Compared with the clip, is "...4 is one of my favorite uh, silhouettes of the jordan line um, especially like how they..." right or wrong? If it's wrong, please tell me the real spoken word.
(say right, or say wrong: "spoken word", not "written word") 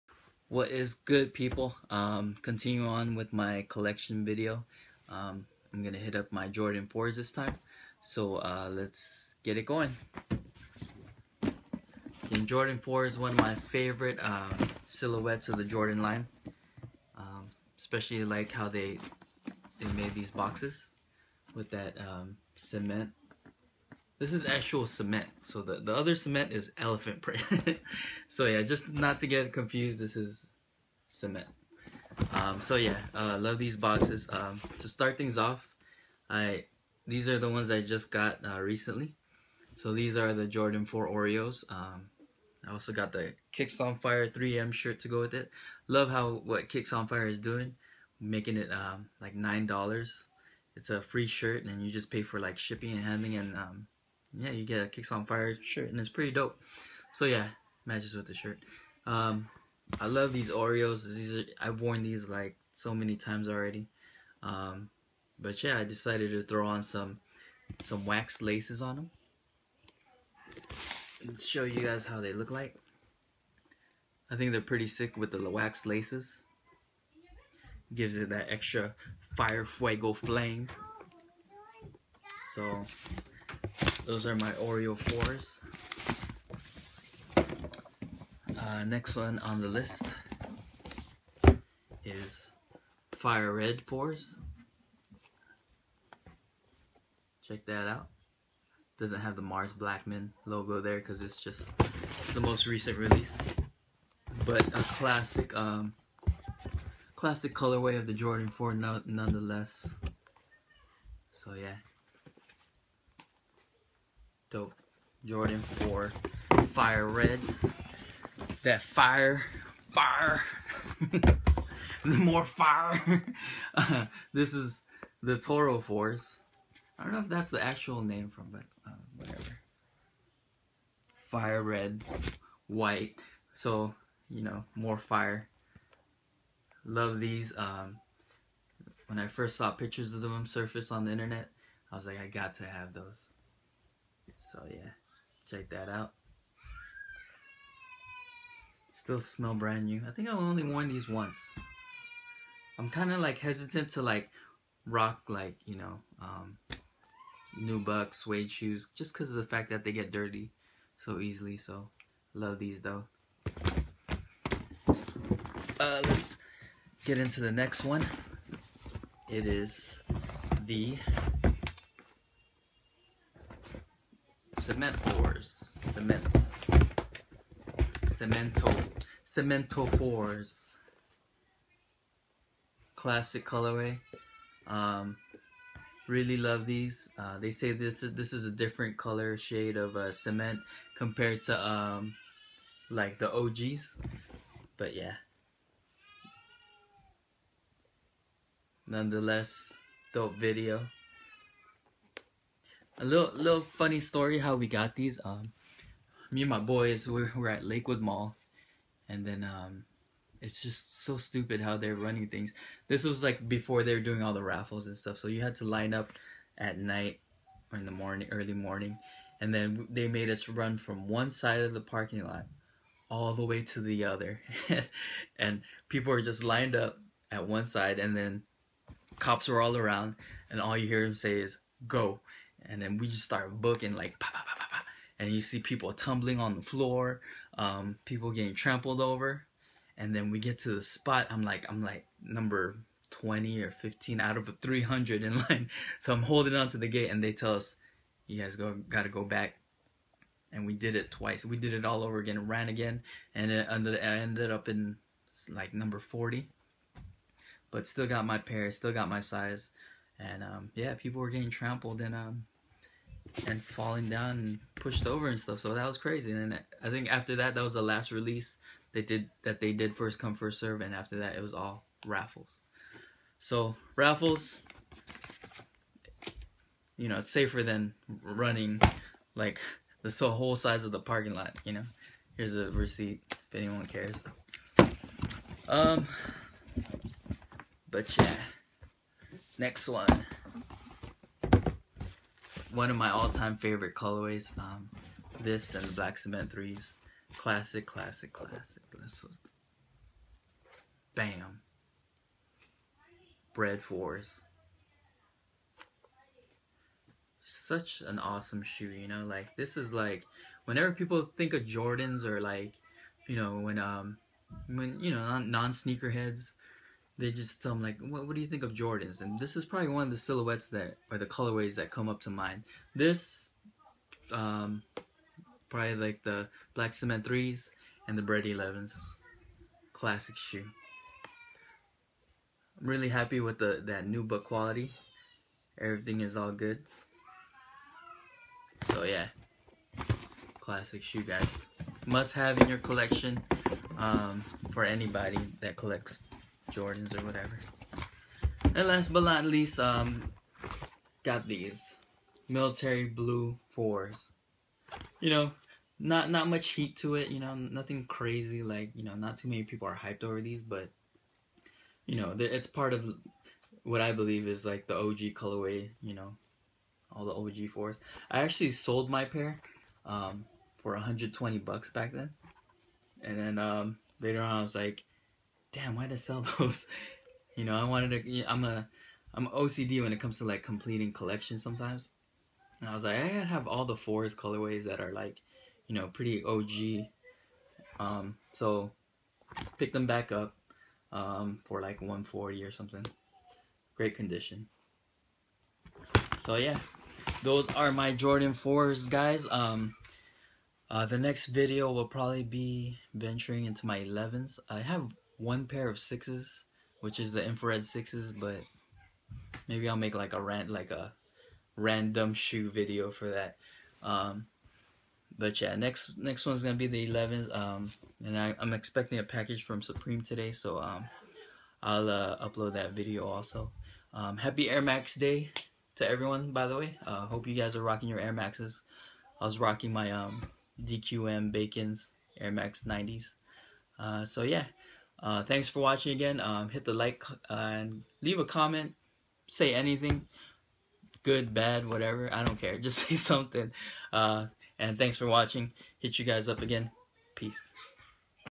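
right.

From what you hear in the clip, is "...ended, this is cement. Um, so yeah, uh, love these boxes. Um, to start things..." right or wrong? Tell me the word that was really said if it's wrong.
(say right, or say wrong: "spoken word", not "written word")
wrong: "confused", not "ended".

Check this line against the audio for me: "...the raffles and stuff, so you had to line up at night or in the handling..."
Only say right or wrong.
wrong.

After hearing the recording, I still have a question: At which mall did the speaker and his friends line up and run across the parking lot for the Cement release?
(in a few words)
Lakewood Mall.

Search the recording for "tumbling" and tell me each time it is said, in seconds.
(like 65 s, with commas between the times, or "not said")
235 s.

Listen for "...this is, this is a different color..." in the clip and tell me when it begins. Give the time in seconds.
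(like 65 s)
187 s.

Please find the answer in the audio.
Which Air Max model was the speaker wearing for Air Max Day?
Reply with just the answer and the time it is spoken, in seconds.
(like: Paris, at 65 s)
Air Max 90s, at 432 s.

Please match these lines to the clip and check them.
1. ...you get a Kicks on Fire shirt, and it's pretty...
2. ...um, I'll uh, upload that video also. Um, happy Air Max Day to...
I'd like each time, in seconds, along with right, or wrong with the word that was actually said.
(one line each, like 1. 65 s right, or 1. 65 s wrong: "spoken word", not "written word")
1. 54 s right
2. 420 s right.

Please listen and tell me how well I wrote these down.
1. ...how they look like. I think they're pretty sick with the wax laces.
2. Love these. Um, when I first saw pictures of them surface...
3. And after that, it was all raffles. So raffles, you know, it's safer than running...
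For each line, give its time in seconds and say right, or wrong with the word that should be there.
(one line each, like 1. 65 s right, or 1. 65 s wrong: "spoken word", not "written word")
1. 72 s right
2. 136 s right
3. 270 s right.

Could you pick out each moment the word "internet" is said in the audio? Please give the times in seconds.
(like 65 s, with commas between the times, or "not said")
141 s.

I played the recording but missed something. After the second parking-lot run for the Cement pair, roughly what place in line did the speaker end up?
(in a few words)
40.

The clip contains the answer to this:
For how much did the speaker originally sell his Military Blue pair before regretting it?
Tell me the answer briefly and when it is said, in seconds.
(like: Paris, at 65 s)
$120, at 370 s.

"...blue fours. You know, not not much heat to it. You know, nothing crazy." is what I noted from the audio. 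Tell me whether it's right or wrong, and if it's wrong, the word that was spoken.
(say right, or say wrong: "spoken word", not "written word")
right.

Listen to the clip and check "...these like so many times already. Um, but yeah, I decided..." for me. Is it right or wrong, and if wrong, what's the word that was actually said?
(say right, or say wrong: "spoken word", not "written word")
right.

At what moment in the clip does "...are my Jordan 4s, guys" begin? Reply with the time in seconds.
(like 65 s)
397 s.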